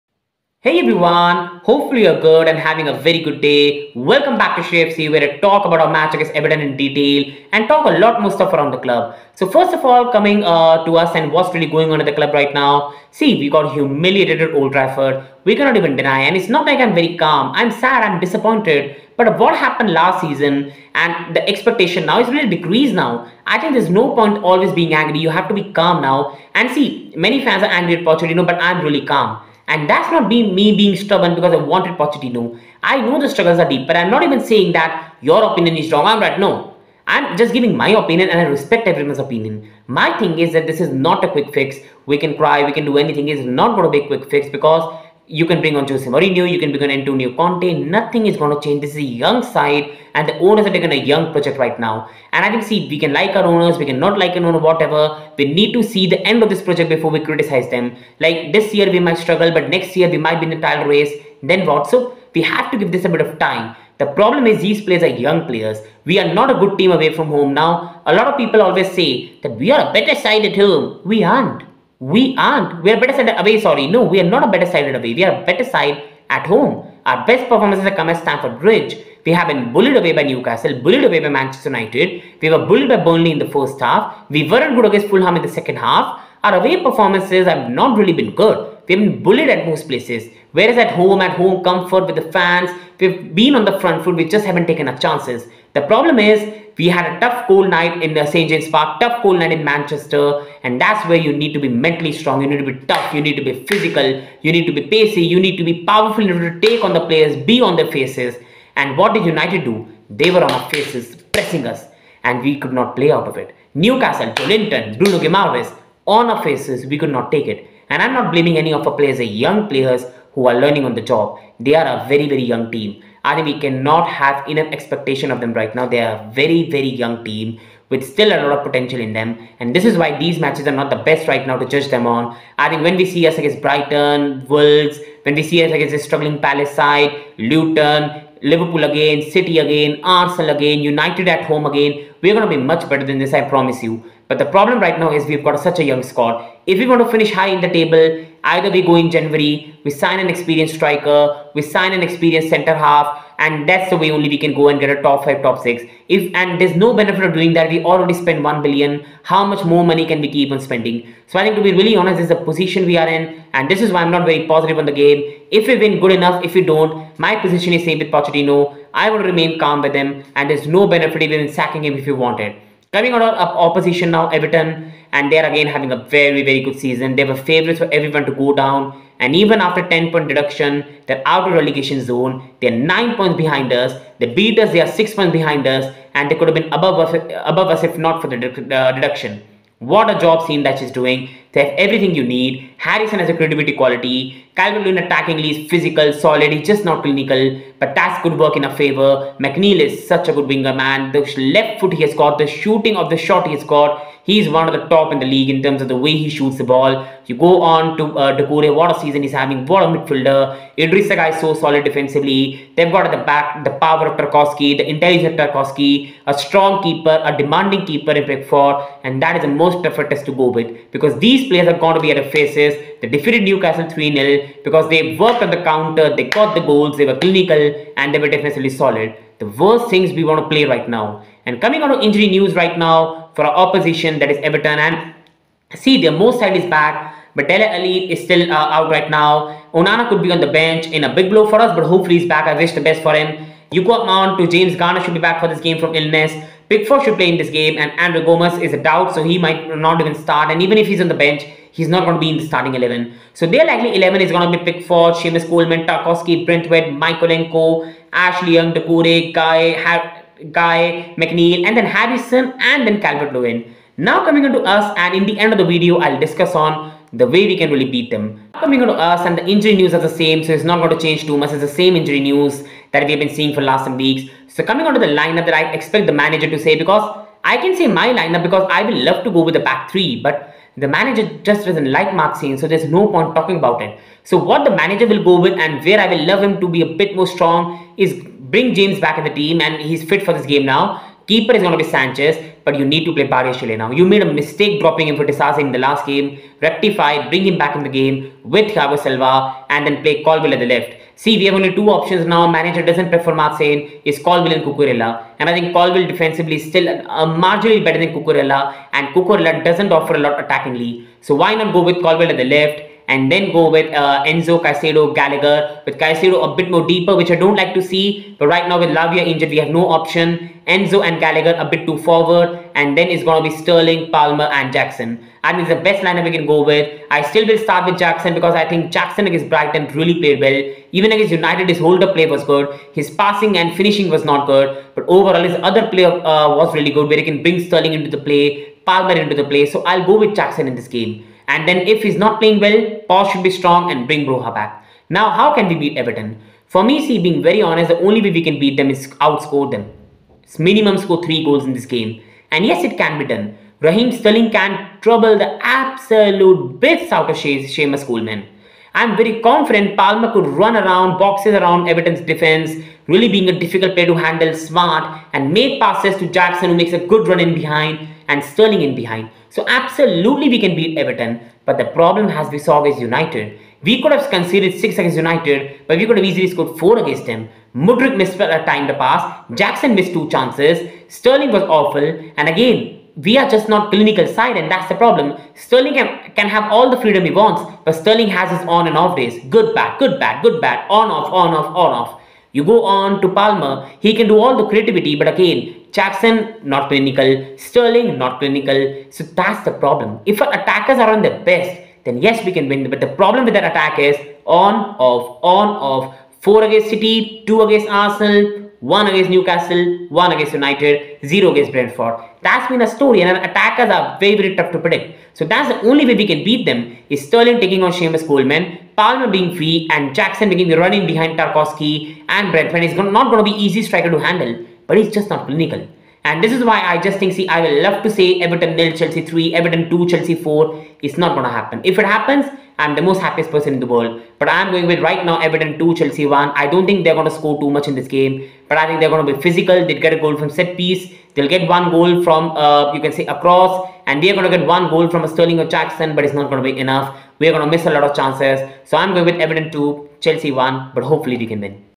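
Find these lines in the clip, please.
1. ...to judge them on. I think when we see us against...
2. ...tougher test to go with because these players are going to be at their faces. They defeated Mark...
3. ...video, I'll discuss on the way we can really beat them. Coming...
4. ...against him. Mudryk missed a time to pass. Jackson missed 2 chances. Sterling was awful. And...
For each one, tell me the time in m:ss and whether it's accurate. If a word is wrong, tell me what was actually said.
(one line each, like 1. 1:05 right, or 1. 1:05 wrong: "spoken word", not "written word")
1. 2:11 right
2. 3:39 wrong: "Newcastle", not "Mark"
3. 4:25 right
4. 6:16 right.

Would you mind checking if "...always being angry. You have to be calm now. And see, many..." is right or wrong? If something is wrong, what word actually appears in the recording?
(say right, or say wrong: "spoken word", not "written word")
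right.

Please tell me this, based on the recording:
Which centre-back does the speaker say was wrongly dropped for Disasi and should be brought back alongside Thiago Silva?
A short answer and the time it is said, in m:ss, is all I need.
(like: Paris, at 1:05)
Badiashile, at 4:53.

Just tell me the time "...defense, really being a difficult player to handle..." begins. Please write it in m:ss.
6:02.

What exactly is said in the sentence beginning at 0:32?
I know the struggles are deep, but I'm not even saying that your opinion is wrong.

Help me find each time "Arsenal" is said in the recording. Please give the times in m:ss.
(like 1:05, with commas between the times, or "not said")
2:20, 6:47.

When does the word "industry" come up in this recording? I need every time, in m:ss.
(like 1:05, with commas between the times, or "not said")
not said.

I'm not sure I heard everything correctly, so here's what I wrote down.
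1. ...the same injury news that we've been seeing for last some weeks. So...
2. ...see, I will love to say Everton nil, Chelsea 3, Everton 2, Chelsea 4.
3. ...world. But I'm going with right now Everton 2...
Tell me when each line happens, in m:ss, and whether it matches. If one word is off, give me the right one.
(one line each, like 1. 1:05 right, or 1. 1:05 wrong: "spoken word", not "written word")
1. 4:31 right
2. 7:07 right
3. 7:13 right.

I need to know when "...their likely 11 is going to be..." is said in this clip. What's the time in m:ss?
4:13.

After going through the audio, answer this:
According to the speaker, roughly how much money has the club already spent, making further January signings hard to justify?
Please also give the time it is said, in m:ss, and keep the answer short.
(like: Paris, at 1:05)
one billion, at 2:38.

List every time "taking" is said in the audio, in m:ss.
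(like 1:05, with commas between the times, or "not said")
0:50, 6:57.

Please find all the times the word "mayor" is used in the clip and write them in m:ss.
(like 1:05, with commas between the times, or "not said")
not said.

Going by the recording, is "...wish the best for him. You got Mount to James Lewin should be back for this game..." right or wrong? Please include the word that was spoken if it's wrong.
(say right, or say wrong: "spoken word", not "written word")
wrong: "Garner", not "Lewin".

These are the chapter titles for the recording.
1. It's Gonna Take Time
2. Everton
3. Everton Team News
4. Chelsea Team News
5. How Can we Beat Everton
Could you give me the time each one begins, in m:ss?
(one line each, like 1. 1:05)
1. 0:15
2. 2:56
3. 3:56
4. 4:35
5. 5:46.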